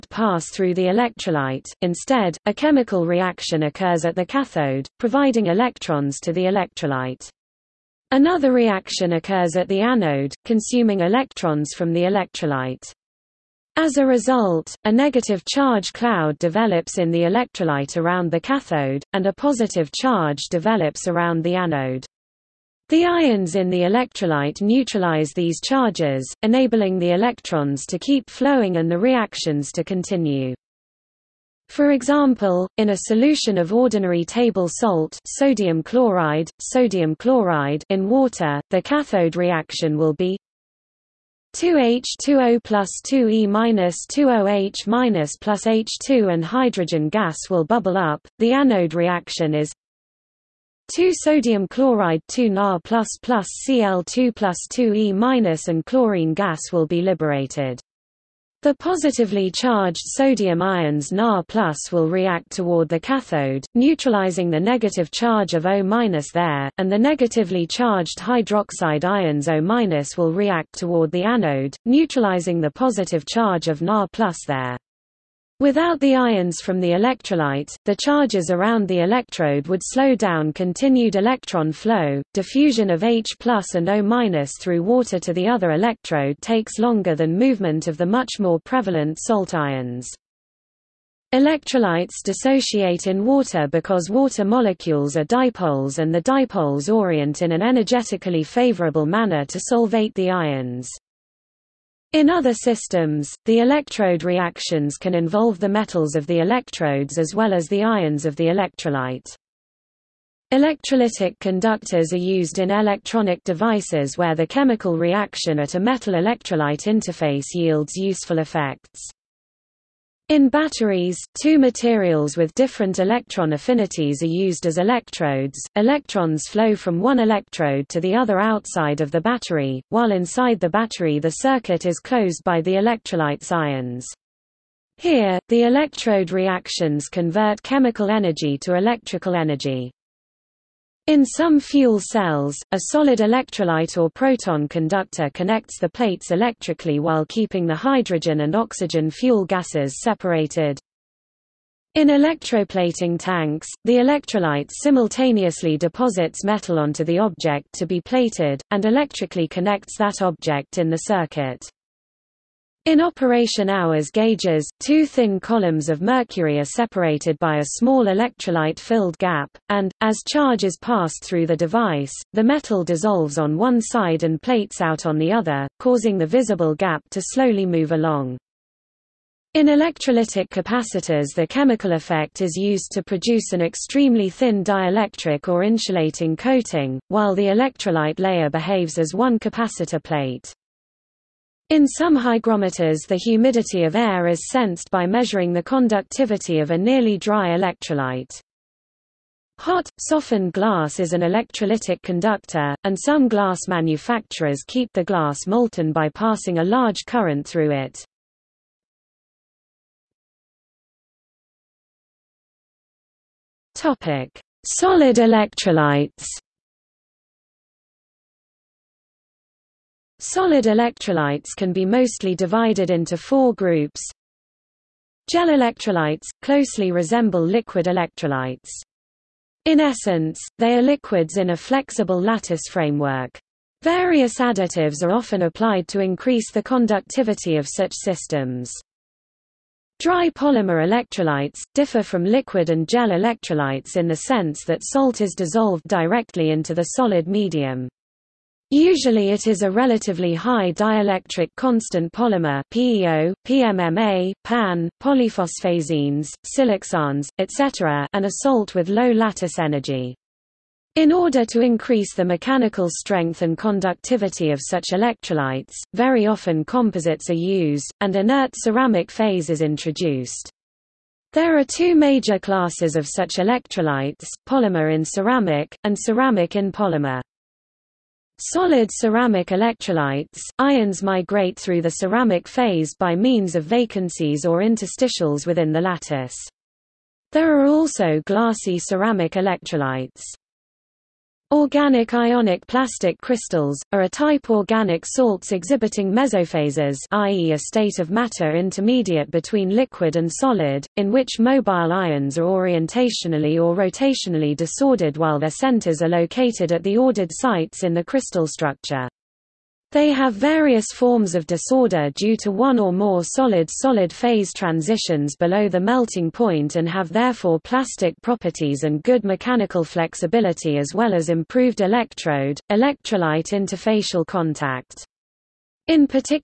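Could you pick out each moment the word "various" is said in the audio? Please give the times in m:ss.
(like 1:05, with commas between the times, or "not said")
3:53, 5:10.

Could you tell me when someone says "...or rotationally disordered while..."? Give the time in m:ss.
5:03.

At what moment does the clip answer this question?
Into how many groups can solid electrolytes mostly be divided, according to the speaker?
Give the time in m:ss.
3:43.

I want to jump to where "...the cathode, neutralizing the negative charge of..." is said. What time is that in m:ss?
1:02.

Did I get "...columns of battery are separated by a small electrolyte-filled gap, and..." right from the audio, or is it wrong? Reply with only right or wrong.
wrong.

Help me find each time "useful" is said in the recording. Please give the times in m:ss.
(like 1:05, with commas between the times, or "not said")
1:57.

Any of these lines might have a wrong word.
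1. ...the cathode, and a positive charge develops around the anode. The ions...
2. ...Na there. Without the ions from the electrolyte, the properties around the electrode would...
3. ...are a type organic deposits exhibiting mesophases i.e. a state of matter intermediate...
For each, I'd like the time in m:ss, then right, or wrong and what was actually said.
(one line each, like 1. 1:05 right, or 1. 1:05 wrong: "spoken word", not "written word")
1. 0:18 right
2. 1:13 wrong: "charges", not "properties"
3. 4:53 wrong: "salts", not "deposits".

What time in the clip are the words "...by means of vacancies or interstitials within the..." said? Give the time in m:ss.
4:42.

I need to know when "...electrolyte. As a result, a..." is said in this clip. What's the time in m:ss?
0:12.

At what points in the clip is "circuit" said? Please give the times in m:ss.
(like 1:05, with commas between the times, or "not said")
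2:11, 2:41.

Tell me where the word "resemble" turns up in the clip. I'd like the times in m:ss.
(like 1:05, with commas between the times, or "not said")
3:46.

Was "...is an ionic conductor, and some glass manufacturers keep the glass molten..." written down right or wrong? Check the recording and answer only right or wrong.
wrong.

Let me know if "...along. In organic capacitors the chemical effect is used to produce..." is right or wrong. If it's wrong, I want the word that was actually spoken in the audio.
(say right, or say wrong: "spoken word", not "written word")
wrong: "electrolytic", not "organic".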